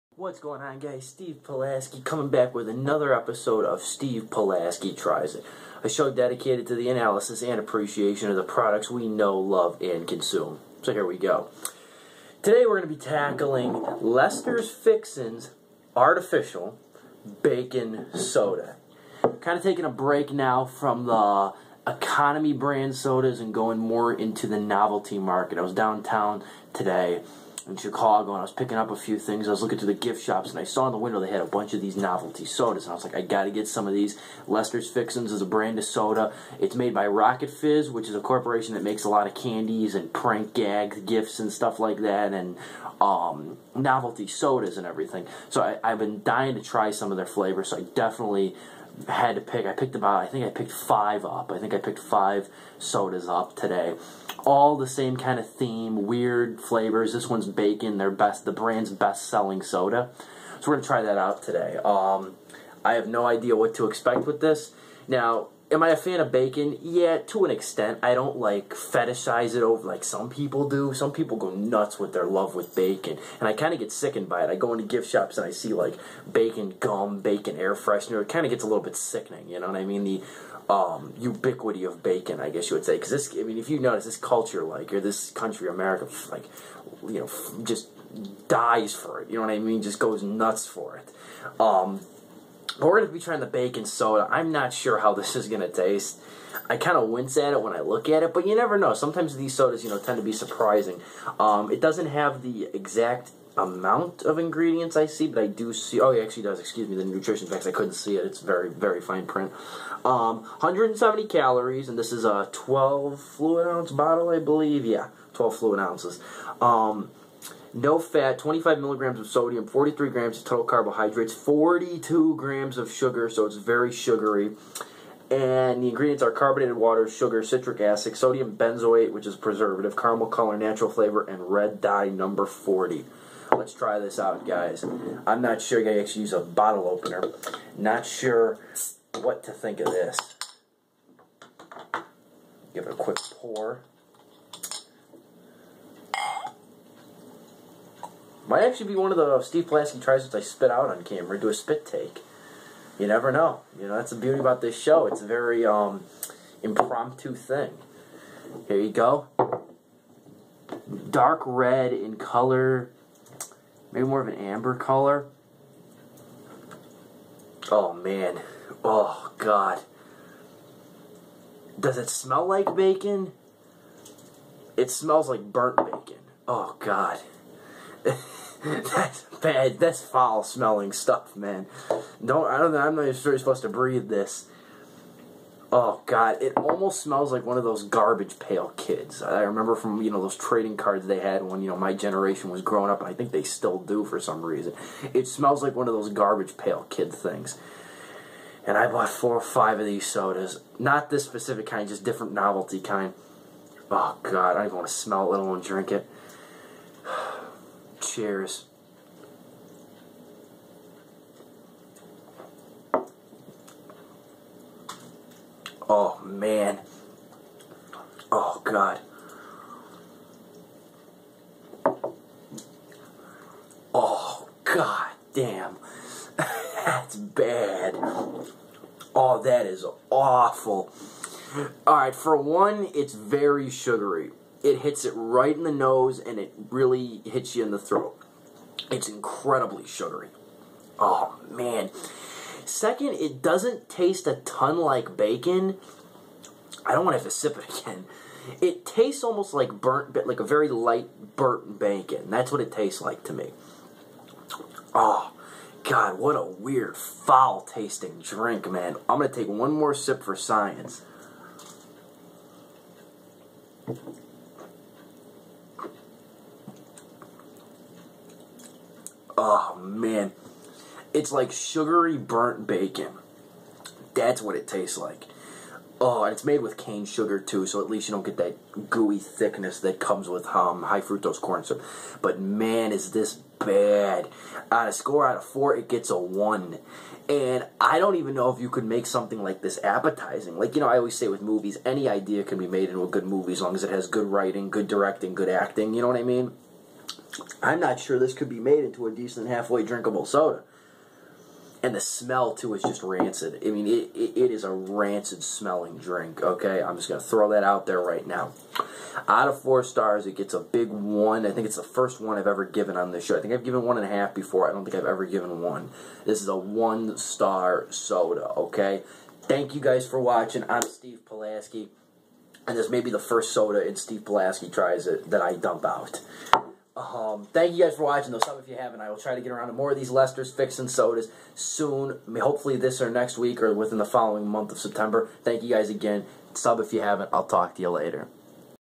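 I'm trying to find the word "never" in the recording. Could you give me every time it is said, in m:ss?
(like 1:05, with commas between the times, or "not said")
1:38, 2:33.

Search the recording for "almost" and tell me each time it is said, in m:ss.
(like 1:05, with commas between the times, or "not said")
3:06, 4:09.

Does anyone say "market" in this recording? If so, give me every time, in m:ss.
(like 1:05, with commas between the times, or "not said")
0:25.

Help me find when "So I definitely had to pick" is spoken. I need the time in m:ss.
0:47.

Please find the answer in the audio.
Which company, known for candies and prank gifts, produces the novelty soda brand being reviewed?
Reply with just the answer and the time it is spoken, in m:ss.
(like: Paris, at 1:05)
Rocket Fizz, at 0:37.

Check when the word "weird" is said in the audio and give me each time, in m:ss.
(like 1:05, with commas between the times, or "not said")
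0:56, 4:16.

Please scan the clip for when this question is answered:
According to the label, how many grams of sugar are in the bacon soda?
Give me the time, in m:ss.
2:01.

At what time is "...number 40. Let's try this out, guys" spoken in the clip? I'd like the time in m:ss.
2:12.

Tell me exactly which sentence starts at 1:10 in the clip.
Some people go nuts with their love with bacon, and I kind of get sickened by it.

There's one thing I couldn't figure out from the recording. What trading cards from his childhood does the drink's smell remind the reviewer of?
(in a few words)
Garbage Pail Kids.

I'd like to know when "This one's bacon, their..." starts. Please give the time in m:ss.
0:57.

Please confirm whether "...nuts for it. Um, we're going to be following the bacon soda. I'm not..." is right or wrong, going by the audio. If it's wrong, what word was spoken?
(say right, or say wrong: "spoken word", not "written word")
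wrong: "trying", not "following".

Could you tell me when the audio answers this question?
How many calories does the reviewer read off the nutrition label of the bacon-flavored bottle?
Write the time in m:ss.
1:50.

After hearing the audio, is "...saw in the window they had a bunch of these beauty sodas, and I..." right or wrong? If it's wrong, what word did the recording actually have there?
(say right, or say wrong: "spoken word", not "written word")
wrong: "novelty", not "beauty".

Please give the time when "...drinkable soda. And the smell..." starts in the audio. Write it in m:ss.
4:59.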